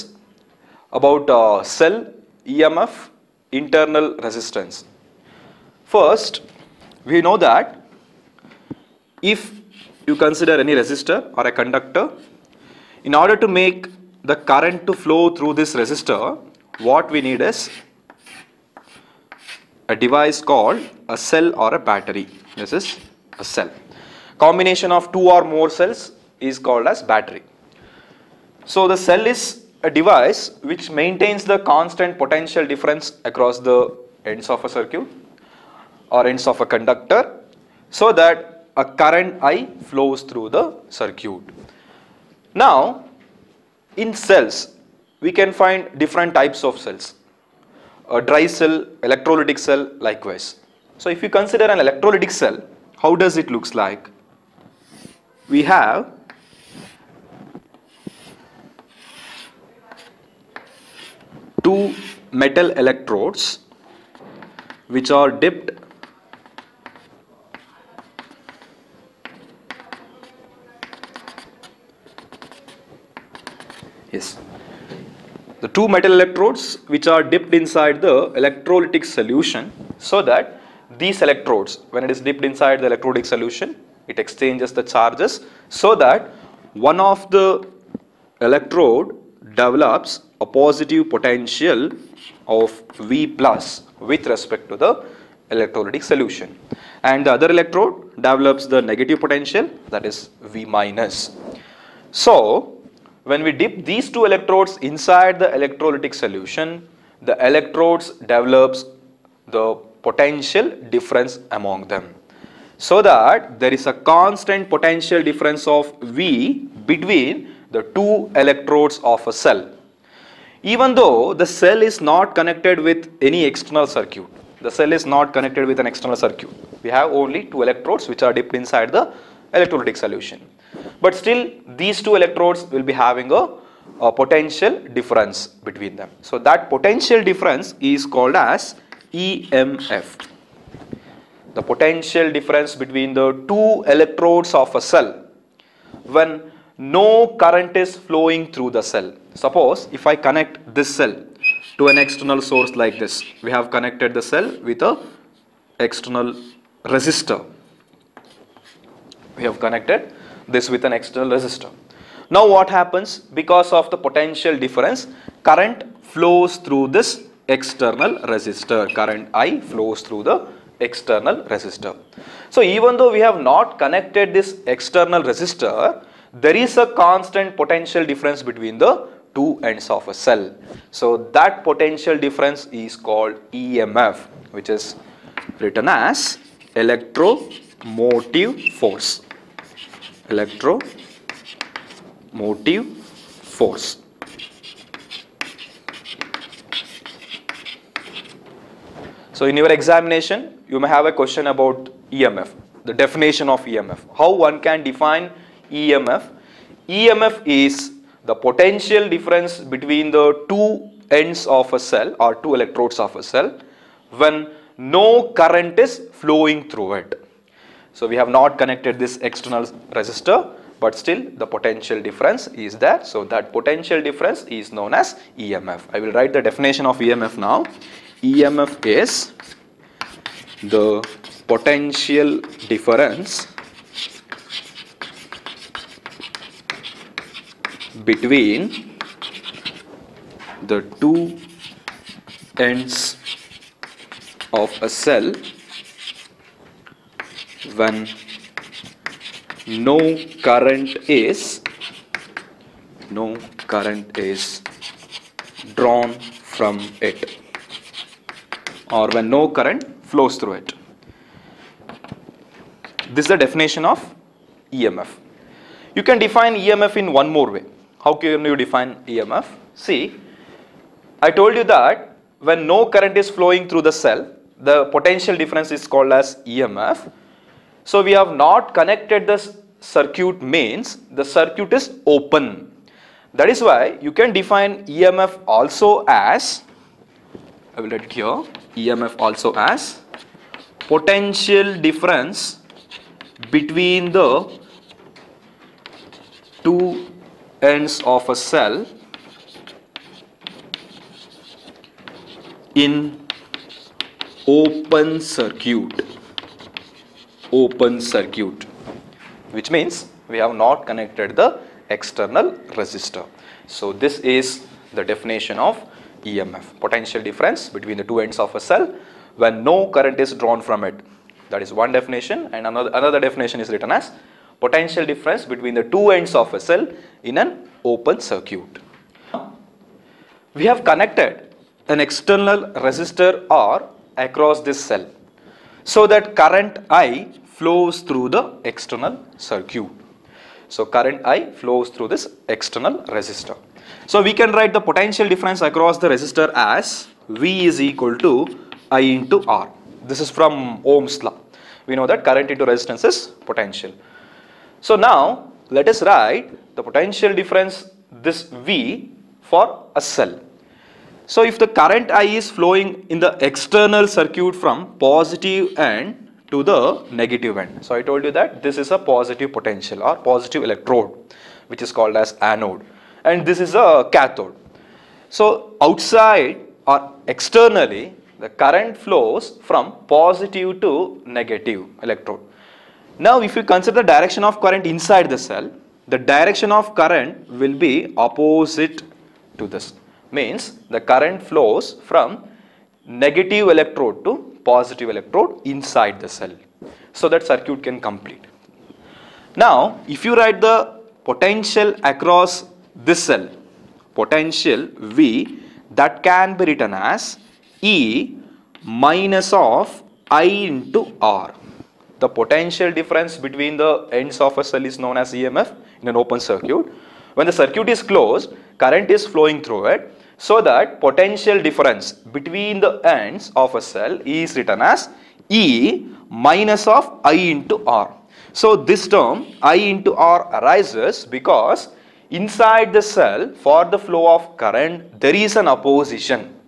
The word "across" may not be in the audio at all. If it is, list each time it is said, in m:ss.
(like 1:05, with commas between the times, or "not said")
0:33, 5:34, 5:45, 6:42.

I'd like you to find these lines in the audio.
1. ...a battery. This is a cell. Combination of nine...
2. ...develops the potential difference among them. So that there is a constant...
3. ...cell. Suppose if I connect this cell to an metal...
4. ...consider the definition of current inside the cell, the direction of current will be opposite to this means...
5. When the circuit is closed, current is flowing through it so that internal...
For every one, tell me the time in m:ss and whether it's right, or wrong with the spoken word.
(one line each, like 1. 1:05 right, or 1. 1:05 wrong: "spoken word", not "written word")
1. 0:21 wrong: "two", not "nine"
2. 1:48 right
3. 2:28 wrong: "external", not "metal"
4. 6:23 wrong: "direction", not "definition"
5. 6:57 wrong: "potential", not "internal".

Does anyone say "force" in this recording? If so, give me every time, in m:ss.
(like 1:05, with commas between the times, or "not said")
3:08, 3:13.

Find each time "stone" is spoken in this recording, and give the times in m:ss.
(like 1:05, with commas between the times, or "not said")
not said.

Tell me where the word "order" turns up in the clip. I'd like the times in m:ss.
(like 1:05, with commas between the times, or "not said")
0:13.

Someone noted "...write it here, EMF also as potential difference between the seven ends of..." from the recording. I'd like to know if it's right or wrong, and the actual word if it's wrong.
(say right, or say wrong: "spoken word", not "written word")
wrong: "two", not "seven".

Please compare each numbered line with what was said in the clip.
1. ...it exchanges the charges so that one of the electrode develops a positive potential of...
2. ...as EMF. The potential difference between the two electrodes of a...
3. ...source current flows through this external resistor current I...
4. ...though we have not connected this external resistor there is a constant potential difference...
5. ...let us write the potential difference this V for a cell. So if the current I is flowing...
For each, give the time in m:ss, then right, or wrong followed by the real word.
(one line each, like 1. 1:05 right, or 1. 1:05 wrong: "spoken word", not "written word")
1. 1:24 right
2. 2:18 right
3. 2:44 wrong: "difference", not "source"
4. 2:52 right
5. 5:55 right.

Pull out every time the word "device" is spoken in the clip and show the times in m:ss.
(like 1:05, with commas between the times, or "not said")
0:19, 0:29.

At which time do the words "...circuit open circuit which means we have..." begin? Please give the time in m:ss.
5:05.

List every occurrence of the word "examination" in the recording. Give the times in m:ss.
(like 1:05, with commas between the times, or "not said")
3:19.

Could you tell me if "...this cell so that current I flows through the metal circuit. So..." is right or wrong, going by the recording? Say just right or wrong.
wrong.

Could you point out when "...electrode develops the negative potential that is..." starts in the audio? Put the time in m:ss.
1:37.